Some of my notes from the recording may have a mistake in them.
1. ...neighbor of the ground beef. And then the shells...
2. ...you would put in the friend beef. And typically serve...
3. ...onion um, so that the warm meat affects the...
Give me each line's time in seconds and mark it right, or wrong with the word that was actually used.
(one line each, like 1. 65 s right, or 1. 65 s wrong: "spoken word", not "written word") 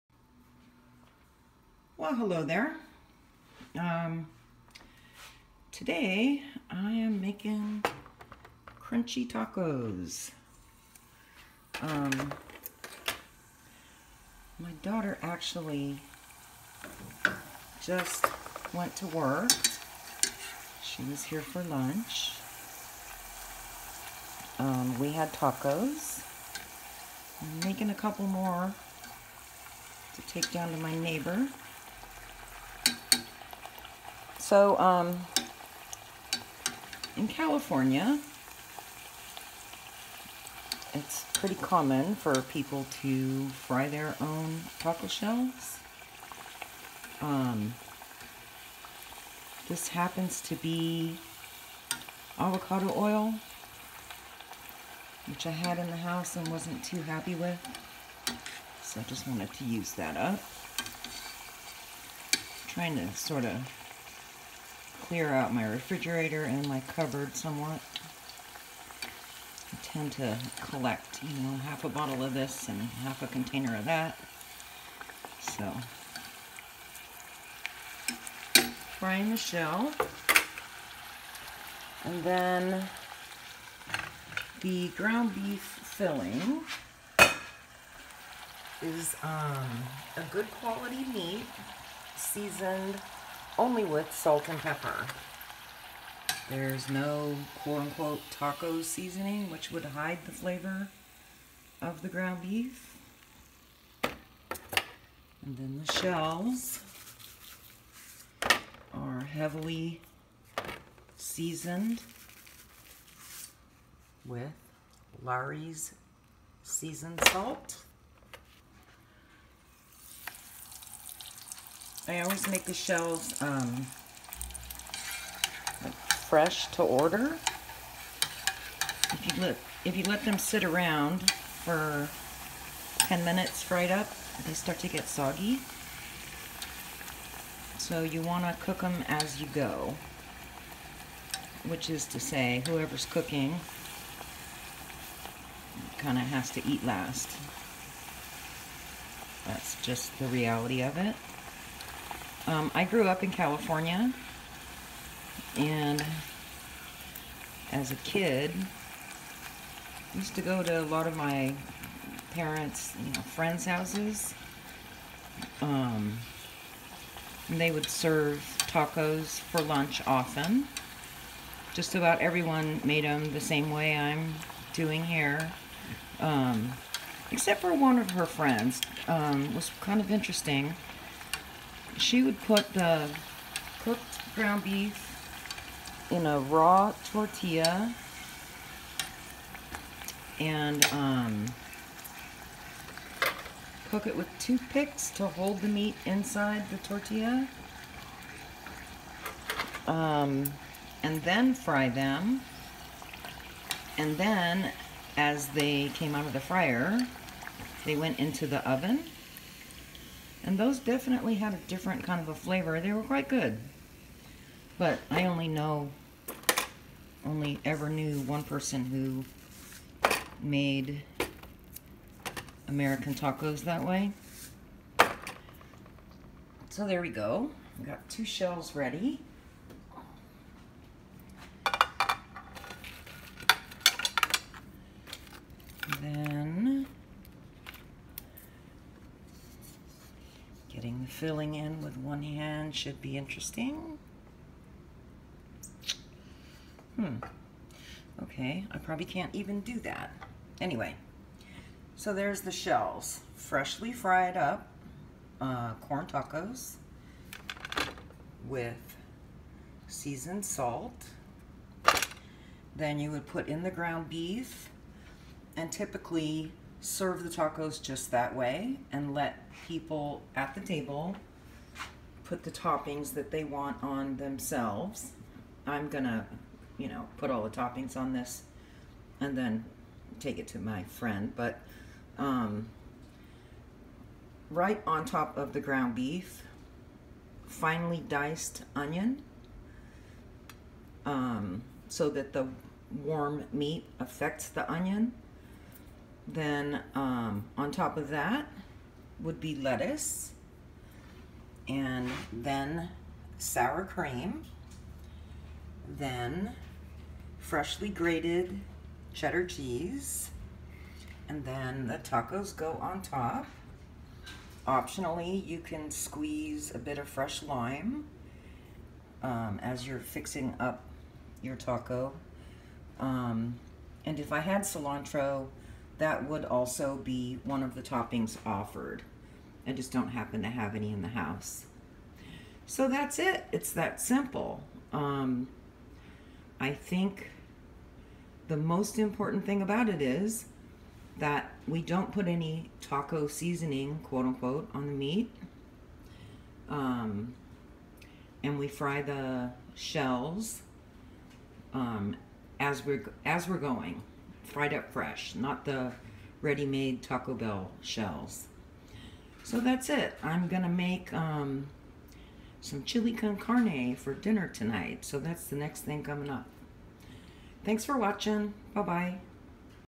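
1. 100 s wrong: "flavor", not "neighbor"
2. 262 s wrong: "ground", not "friend"
3. 288 s right.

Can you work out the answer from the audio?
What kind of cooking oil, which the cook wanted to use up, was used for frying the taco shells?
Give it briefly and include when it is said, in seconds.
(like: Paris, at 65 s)
Avocado oil, at 52 s.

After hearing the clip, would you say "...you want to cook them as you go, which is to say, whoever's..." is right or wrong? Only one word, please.
right.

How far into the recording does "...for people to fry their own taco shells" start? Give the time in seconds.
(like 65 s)
42 s.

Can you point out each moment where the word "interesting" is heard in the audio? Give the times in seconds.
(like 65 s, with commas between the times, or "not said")
180 s, 243 s.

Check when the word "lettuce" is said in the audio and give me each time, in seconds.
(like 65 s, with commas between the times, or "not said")
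299 s.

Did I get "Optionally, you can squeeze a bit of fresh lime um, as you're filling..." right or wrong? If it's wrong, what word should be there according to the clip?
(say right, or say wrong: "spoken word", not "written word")
wrong: "fixing", not "filling".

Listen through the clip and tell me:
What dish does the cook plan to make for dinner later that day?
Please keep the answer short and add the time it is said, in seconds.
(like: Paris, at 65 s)
Chili con carne, at 362 s.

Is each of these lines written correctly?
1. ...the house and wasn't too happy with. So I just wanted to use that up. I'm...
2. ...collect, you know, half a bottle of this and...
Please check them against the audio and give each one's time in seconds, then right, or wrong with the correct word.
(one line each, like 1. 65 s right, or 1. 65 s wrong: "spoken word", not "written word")
1. 55 s right
2. 70 s right.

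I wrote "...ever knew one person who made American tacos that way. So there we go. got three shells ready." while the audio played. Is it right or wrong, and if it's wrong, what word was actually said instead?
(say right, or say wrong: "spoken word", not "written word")
wrong: "two", not "three".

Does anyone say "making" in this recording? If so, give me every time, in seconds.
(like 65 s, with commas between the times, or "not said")
7 s, 27 s.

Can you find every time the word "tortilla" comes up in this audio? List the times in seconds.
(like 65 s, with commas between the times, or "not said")
187 s, 196 s.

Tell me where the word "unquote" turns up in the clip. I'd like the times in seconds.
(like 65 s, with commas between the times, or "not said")
97 s, 344 s.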